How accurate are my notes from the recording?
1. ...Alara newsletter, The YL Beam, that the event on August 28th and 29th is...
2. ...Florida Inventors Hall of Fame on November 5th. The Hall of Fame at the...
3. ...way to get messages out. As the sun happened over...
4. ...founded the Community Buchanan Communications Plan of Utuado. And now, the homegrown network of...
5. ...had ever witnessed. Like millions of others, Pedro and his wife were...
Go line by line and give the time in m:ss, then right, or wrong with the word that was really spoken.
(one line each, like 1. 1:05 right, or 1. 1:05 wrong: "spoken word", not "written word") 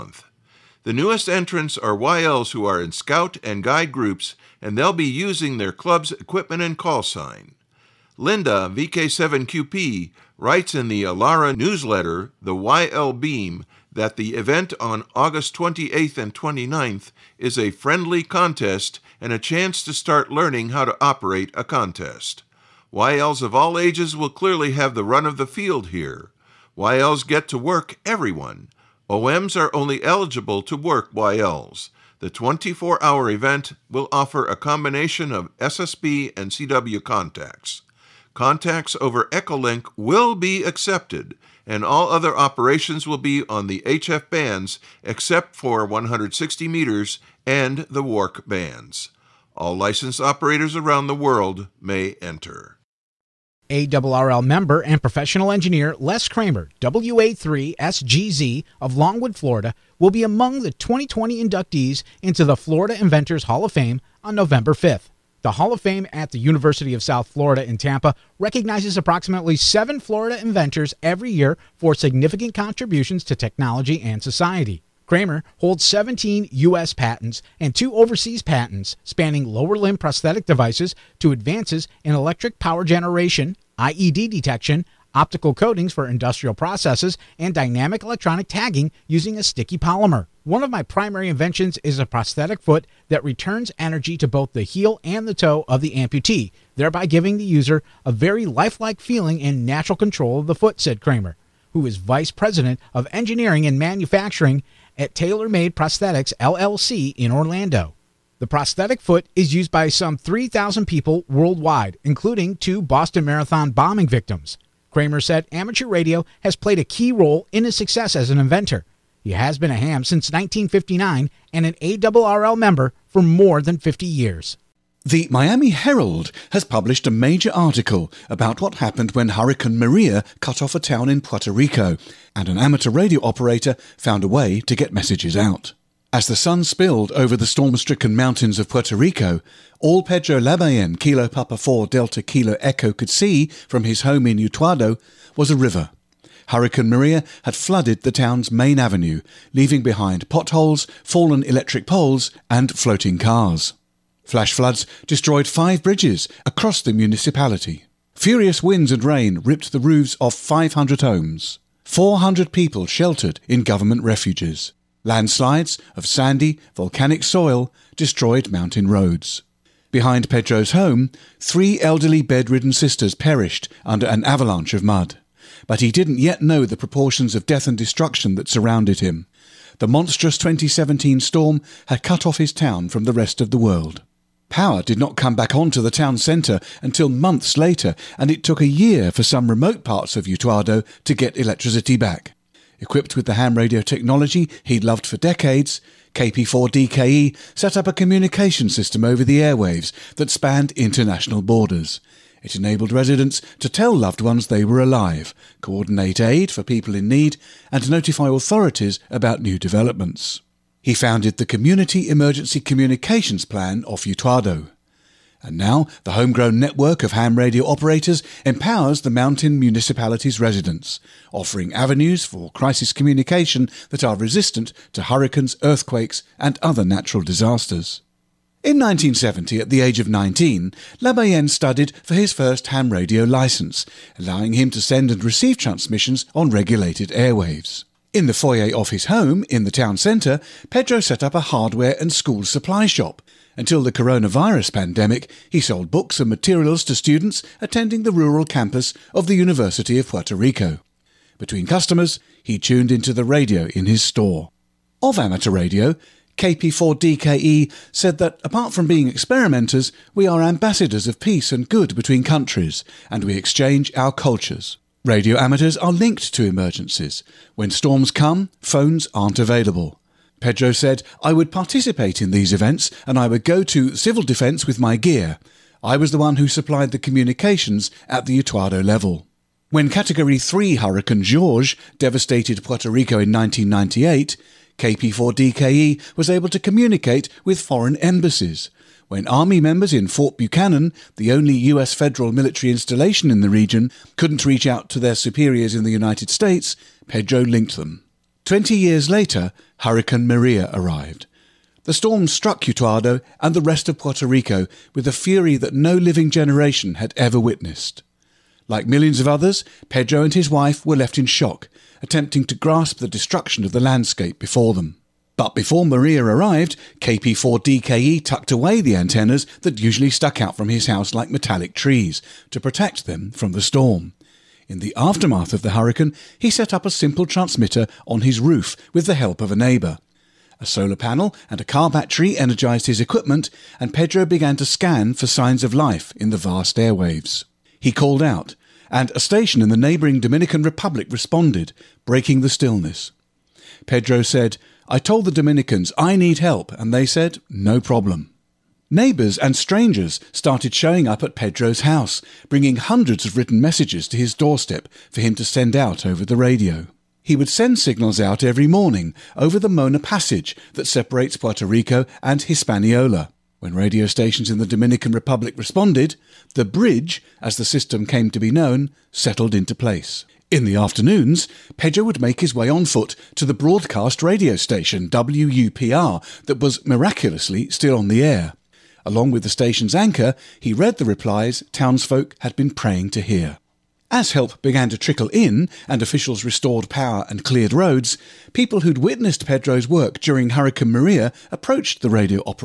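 1. 0:11 right
2. 1:02 right
3. 2:14 wrong: "spilled", not "happened"
4. 3:30 wrong: "Emergency", not "Buchanan"
5. 5:06 right.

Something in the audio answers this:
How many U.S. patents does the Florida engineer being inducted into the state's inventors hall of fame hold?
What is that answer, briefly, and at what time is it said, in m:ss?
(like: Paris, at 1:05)
17, at 1:15.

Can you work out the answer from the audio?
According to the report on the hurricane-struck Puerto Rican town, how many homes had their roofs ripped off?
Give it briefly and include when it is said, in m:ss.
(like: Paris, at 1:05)
500, at 2:40.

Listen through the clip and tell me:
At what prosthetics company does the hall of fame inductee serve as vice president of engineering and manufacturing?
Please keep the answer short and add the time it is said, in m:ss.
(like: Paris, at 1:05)
Tailor Made Prosthetics, at 1:45.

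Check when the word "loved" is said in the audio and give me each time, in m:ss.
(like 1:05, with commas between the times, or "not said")
3:14, 3:23.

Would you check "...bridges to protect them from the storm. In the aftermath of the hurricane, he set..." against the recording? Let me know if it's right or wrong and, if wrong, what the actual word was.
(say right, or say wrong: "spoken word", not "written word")
wrong: "trees", not "bridges".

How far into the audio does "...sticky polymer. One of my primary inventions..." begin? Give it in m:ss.
1:29.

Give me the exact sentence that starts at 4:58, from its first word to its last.
Twenty years later, Hurricane Maria arrived.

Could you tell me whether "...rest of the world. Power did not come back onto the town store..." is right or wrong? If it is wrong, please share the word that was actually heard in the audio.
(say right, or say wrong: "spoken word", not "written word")
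wrong: "centre", not "store".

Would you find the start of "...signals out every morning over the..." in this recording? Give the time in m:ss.
5:57.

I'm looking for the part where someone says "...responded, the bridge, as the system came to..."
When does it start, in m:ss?
6:05.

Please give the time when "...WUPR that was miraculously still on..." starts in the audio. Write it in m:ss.
6:15.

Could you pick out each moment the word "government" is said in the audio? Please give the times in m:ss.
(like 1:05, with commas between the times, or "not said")
2:43.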